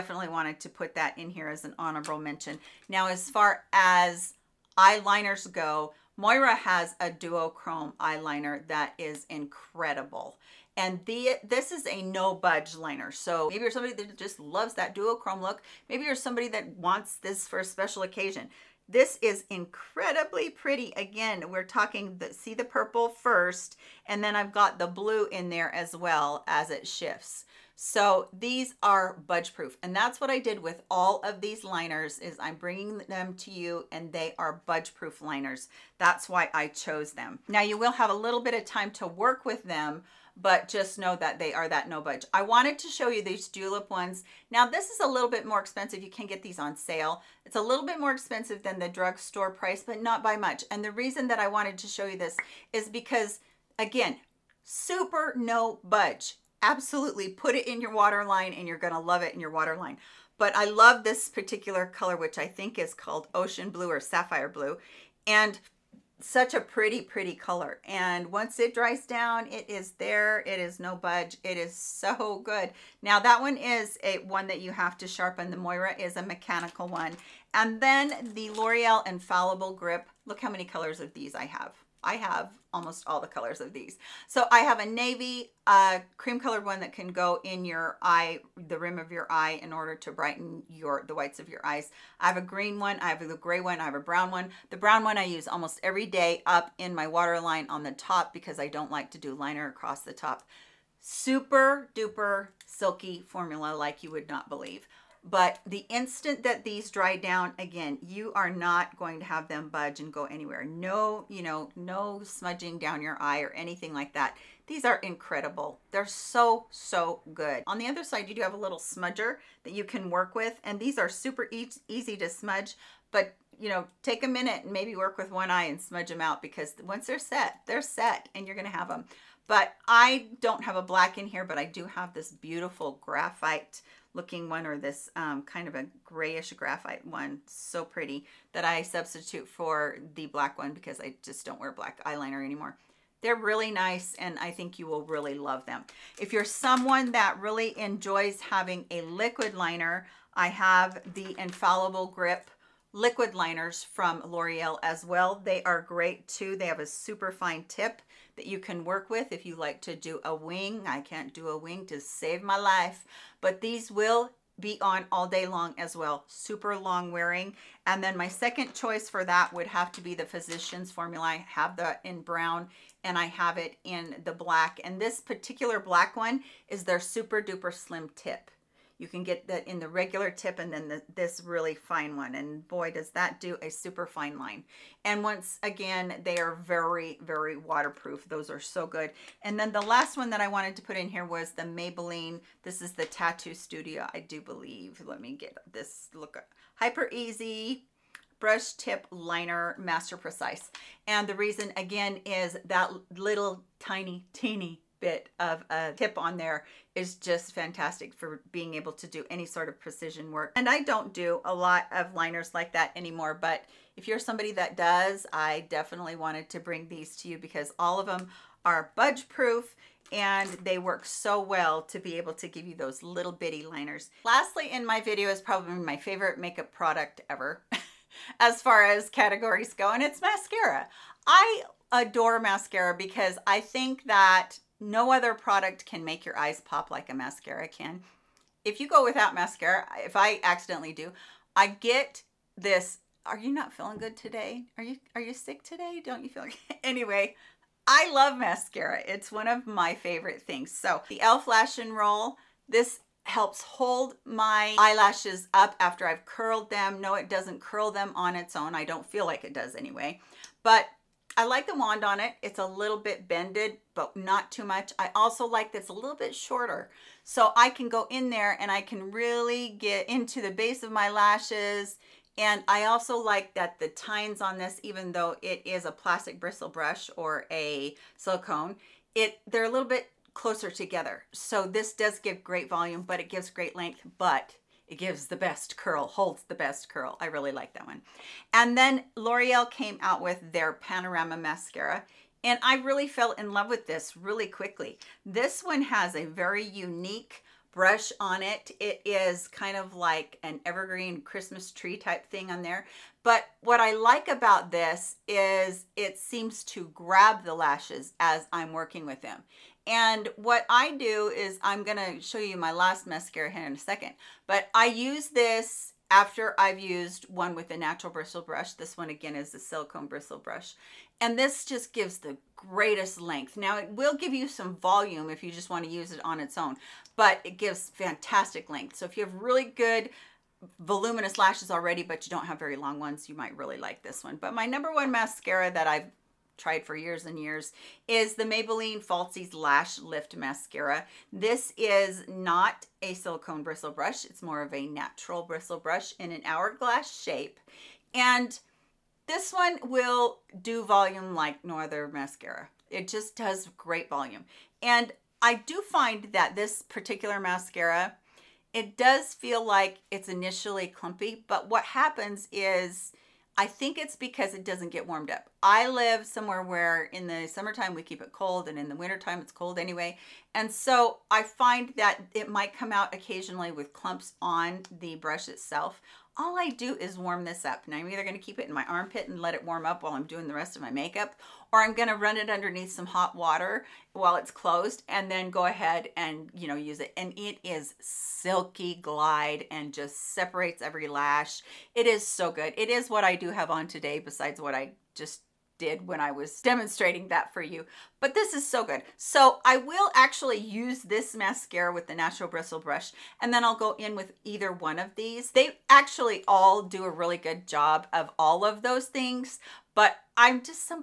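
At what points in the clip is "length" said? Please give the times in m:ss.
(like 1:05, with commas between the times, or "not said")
4:43, 5:23, 5:28.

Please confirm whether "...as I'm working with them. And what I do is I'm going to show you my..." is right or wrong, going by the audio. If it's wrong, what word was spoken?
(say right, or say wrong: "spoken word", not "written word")
right.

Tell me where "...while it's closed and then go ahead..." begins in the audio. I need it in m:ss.
6:24.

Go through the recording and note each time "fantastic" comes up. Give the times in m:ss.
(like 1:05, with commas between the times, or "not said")
3:27, 5:27.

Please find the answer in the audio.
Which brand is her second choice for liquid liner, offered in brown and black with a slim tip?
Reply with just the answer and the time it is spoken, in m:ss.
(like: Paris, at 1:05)
Physicians Formula, at 2:50.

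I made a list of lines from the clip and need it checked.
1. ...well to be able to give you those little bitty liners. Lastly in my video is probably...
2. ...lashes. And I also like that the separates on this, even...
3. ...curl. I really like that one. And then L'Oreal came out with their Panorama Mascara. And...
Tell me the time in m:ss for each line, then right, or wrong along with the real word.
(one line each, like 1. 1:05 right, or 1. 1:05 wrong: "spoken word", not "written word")
1. 3:41 right
2. 4:31 wrong: "tines", not "separates"
3. 4:46 right.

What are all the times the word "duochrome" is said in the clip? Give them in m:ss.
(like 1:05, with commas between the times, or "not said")
0:07, 0:14.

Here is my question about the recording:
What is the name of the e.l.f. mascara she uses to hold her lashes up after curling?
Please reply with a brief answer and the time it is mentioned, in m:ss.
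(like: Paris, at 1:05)
Lash and Roll, at 4:11.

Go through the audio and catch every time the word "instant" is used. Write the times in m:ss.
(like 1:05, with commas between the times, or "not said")
1:45.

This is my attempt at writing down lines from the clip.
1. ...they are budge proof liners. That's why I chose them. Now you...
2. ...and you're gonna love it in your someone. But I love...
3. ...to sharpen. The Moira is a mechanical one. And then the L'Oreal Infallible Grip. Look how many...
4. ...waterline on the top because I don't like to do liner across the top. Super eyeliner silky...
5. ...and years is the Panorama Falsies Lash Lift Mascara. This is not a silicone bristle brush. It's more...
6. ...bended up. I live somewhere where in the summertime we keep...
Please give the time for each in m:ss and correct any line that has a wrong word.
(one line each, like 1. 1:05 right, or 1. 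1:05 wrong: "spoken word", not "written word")
1. 0:34 right
2. 0:58 wrong: "waterline", not "someone"
3. 1:14 right
4. 1:37 wrong: "duper", not "eyeliner"
5. 5:37 wrong: "Maybelline", not "Panorama"
6. 6:05 wrong: "warmed", not "bended".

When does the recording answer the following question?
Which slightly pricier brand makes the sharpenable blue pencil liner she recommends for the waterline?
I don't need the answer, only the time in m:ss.
0:43.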